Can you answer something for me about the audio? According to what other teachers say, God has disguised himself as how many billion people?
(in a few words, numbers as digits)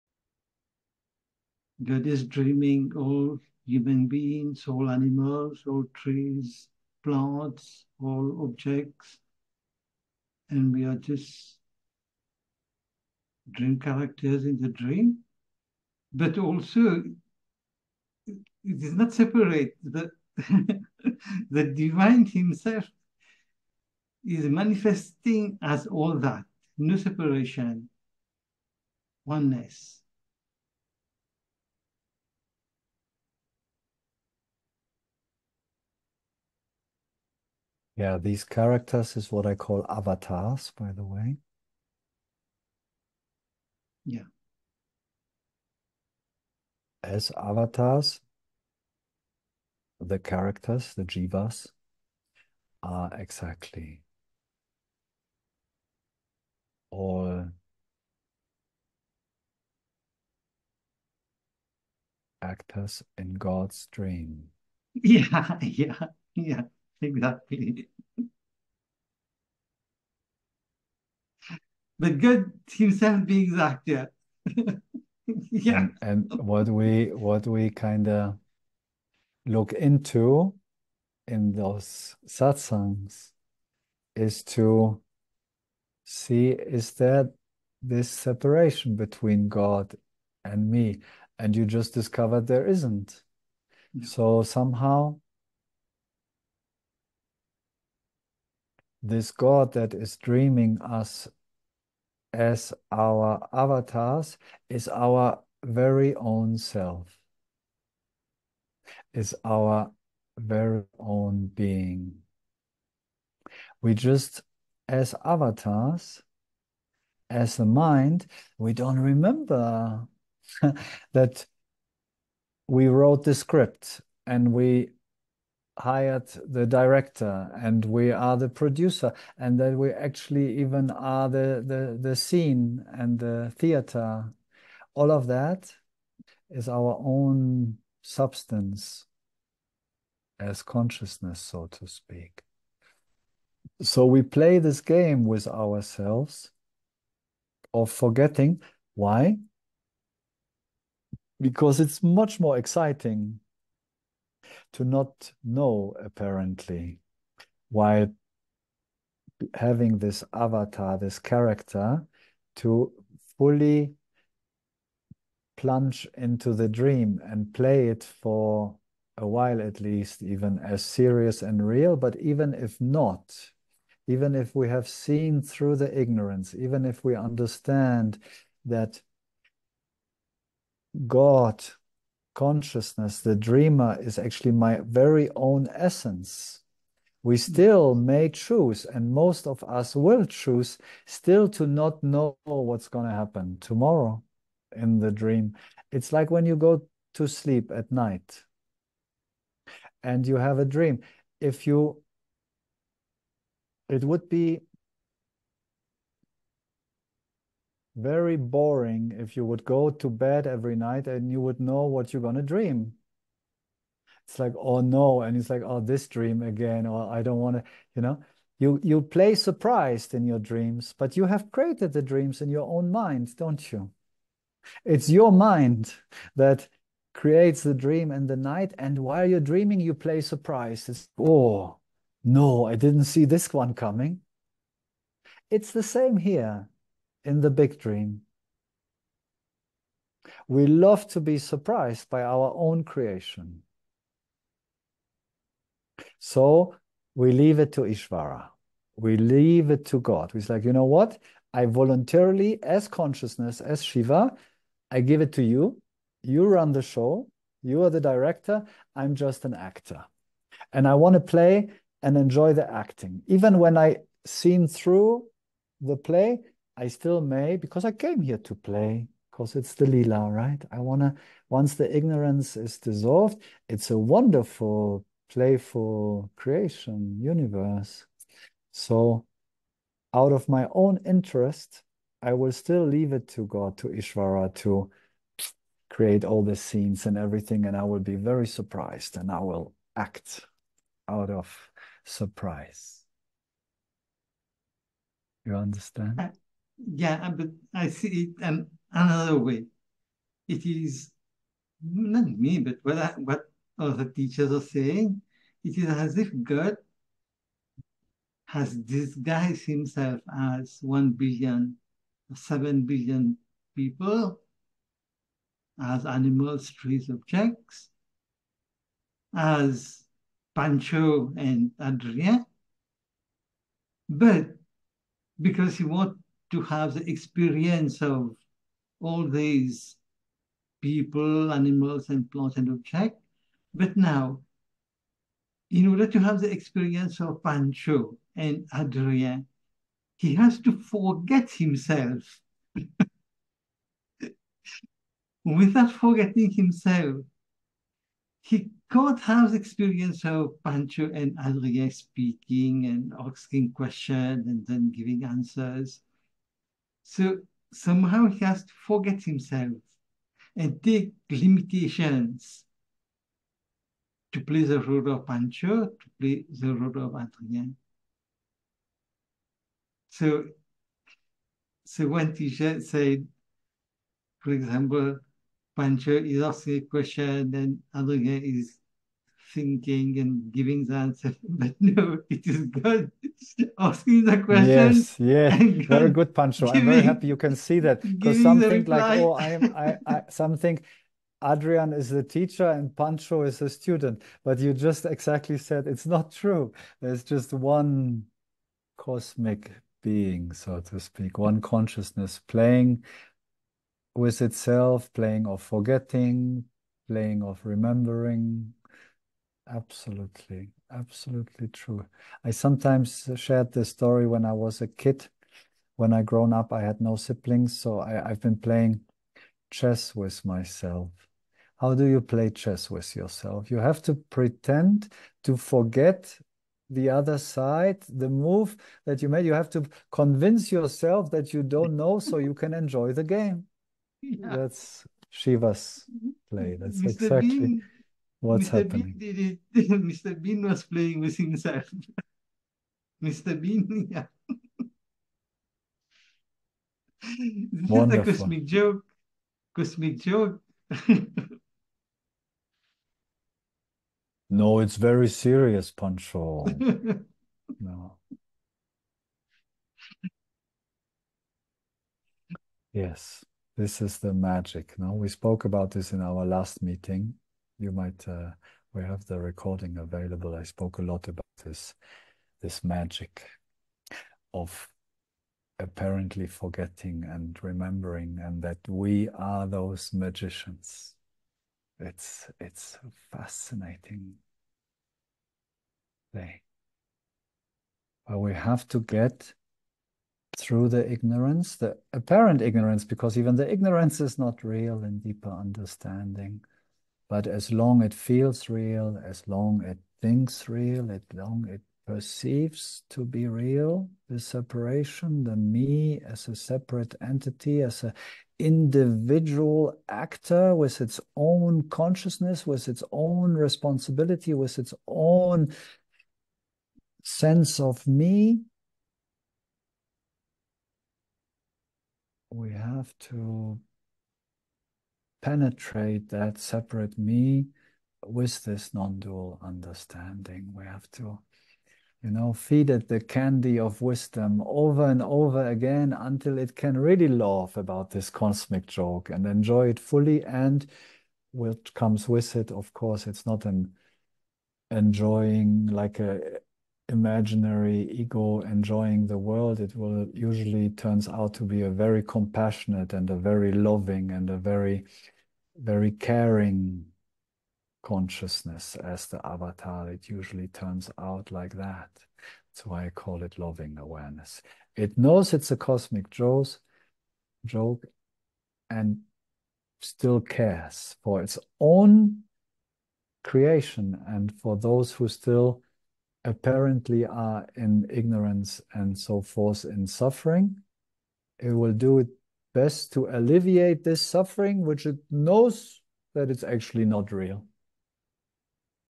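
7 billion.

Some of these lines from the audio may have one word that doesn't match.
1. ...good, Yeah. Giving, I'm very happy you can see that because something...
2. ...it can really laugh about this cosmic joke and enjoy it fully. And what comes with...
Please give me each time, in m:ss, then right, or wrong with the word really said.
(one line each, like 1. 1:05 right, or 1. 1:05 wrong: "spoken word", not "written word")
1. 6:26 wrong: "Pancho", not "Yeah"
2. 8:56 right.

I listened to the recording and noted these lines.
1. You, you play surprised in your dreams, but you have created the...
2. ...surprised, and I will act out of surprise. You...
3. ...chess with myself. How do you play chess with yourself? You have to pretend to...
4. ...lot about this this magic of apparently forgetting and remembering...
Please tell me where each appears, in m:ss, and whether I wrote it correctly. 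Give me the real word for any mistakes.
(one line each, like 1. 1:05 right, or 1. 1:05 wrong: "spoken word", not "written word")
1. 3:38 right
2. 4:48 right
3. 6:59 right
4. 7:51 right.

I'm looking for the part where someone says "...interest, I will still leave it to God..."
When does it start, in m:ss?
4:41.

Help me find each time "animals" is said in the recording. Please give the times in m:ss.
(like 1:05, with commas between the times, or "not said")
0:04, 5:16, 5:31.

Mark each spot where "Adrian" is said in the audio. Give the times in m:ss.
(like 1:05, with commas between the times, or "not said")
5:21, 5:38, 5:51, 6:07, 6:17, 6:31.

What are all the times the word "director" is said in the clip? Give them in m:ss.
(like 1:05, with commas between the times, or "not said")
2:06, 4:18.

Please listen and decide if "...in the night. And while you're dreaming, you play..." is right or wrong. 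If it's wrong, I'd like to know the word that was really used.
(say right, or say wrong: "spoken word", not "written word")
right.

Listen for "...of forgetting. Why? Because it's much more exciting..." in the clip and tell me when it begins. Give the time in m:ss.
2:27.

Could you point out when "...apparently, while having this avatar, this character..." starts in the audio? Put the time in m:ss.
2:36.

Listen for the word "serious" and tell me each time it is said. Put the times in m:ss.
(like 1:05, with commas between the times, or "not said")
2:50, 7:35.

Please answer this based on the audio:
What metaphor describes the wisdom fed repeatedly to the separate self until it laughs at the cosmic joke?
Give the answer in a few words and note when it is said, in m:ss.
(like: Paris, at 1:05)
candy of wisdom, at 8:53.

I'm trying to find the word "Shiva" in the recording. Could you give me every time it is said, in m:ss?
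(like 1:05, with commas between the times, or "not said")
4:13, 7:15.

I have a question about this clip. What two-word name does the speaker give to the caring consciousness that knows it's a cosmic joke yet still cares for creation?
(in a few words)
loving awareness.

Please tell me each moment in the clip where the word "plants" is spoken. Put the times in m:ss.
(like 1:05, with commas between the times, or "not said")
0:07, 5:32.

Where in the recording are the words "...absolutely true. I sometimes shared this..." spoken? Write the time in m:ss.
6:50.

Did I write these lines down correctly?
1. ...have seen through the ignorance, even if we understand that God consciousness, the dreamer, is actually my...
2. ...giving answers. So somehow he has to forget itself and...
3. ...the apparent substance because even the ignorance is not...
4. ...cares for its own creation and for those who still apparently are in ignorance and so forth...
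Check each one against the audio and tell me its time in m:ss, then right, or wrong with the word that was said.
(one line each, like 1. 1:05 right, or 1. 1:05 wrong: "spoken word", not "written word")
1. 2:54 right
2. 5:54 wrong: "himself", not "itself"
3. 8:11 wrong: "ignorance", not "substance"
4. 9:30 right.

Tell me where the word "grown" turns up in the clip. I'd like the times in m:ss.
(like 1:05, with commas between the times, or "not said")
6:56.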